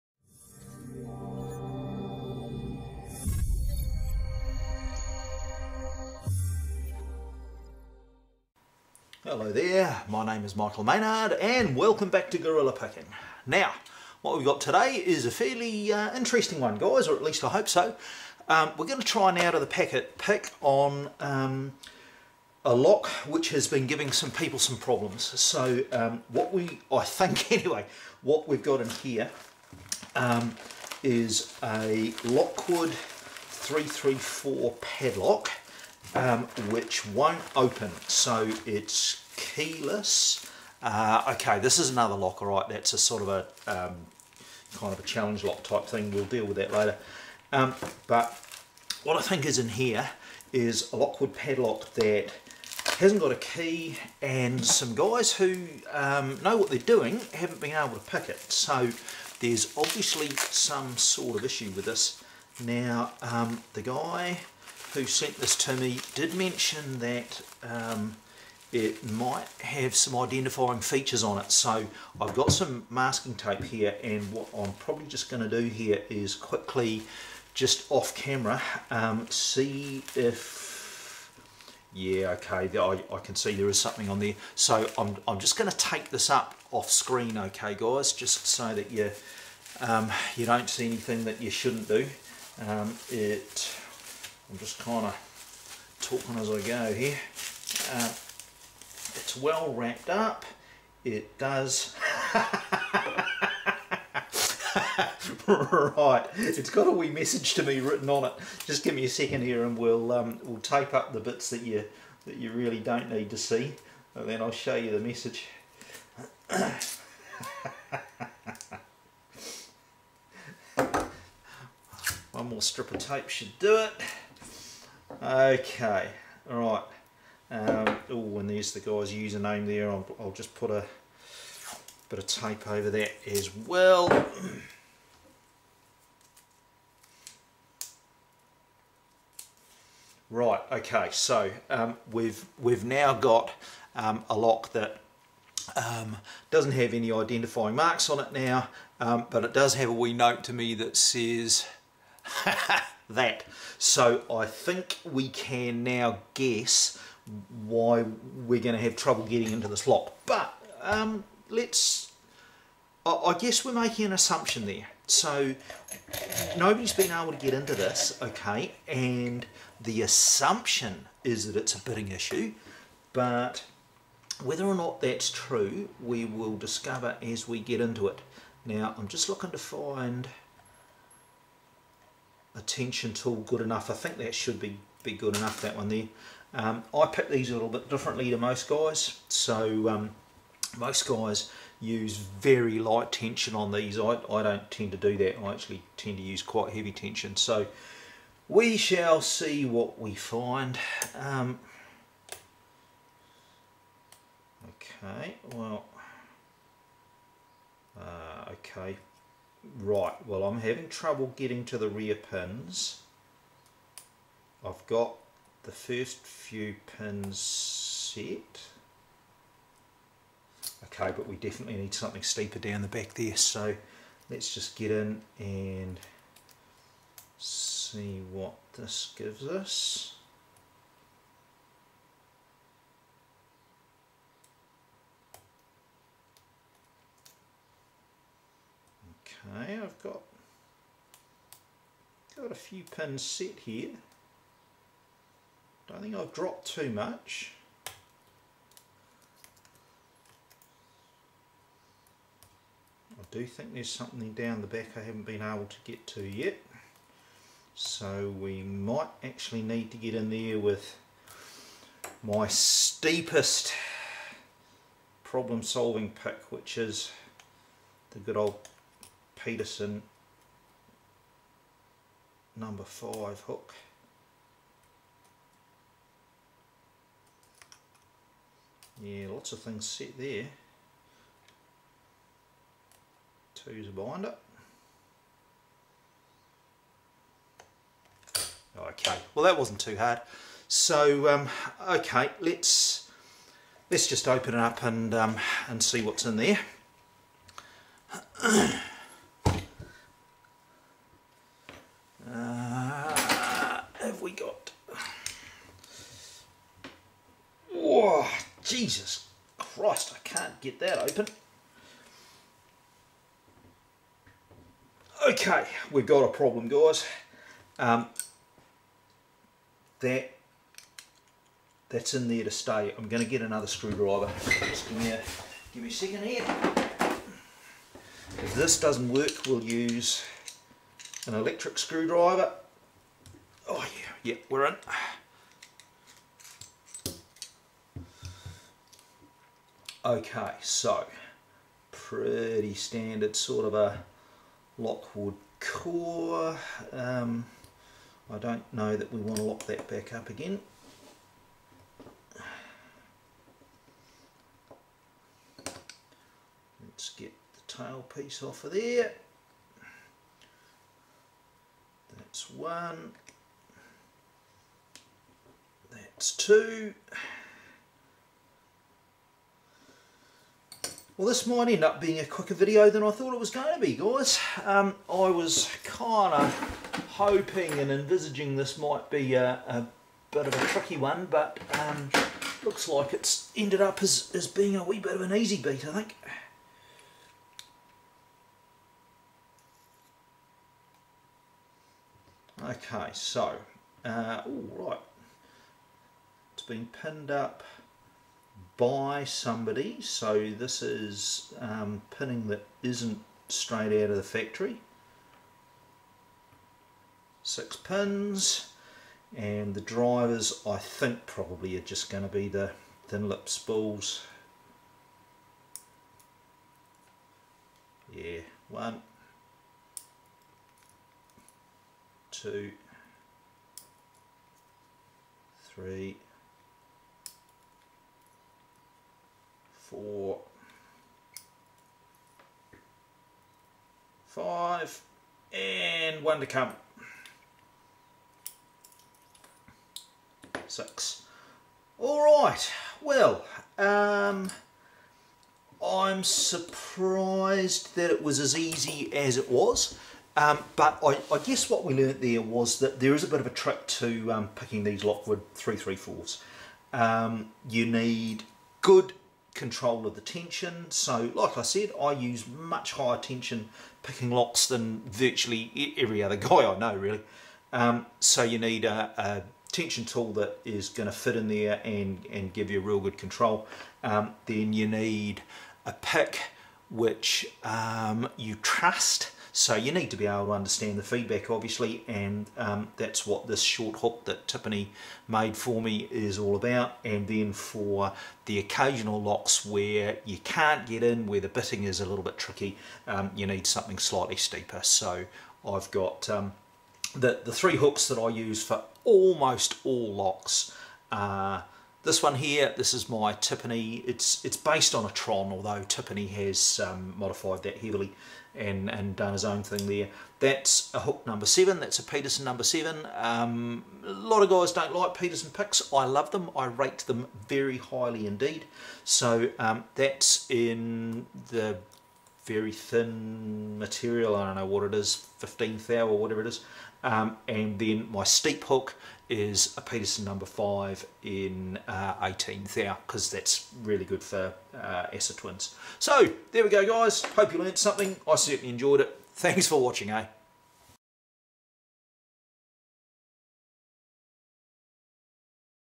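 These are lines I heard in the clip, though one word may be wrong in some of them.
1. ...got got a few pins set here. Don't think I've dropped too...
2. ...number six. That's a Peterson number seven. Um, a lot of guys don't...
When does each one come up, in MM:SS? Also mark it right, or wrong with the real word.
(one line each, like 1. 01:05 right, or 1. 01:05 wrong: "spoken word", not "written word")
1. 04:00 right
2. 08:31 wrong: "seven", not "six".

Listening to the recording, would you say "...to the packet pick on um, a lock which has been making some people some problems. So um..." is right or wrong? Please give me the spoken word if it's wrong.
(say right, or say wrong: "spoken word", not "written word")
wrong: "giving", not "making".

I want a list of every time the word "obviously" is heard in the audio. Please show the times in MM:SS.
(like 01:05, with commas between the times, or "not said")
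00:59, 08:01.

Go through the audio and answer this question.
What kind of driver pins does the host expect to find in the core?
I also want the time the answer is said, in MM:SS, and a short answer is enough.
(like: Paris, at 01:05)
thin lip spools, at 06:53.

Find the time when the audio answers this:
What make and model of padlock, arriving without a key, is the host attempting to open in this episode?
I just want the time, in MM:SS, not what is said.
00:32.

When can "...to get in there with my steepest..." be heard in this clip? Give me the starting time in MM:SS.
04:19.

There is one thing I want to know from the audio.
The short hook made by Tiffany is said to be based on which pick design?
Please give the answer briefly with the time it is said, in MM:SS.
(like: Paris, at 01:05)
Tron, at 08:25.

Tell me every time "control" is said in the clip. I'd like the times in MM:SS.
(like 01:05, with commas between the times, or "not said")
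07:39, 07:53.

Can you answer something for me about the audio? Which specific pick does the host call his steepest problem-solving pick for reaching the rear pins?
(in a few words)
Peterson number 5 hook.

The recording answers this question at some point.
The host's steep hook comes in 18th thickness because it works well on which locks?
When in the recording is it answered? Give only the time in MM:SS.
08:55.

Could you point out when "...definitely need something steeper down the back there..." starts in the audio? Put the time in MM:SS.
03:41.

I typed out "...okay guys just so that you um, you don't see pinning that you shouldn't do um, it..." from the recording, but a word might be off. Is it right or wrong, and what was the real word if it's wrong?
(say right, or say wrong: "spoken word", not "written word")
wrong: "anything", not "pinning".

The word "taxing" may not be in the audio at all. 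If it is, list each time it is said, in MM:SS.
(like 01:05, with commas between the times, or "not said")
not said.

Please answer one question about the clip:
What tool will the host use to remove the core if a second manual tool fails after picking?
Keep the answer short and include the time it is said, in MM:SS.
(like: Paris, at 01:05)
electric screwdriver, at 05:31.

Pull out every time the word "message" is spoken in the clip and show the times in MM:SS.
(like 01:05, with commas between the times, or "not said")
01:47, 01:54.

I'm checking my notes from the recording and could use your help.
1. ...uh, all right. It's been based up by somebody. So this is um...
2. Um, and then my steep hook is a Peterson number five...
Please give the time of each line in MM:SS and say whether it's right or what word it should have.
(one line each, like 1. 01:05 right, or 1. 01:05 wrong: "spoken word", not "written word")
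1. 06:34 wrong: "pinned", not "based"
2. 08:47 right.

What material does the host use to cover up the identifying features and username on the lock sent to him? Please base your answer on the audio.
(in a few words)
masking tape.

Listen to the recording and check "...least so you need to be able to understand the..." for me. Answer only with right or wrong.
wrong.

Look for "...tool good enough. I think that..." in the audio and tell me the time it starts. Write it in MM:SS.
03:03.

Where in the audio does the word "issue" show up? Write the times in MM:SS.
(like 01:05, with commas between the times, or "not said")
01:01, 02:52.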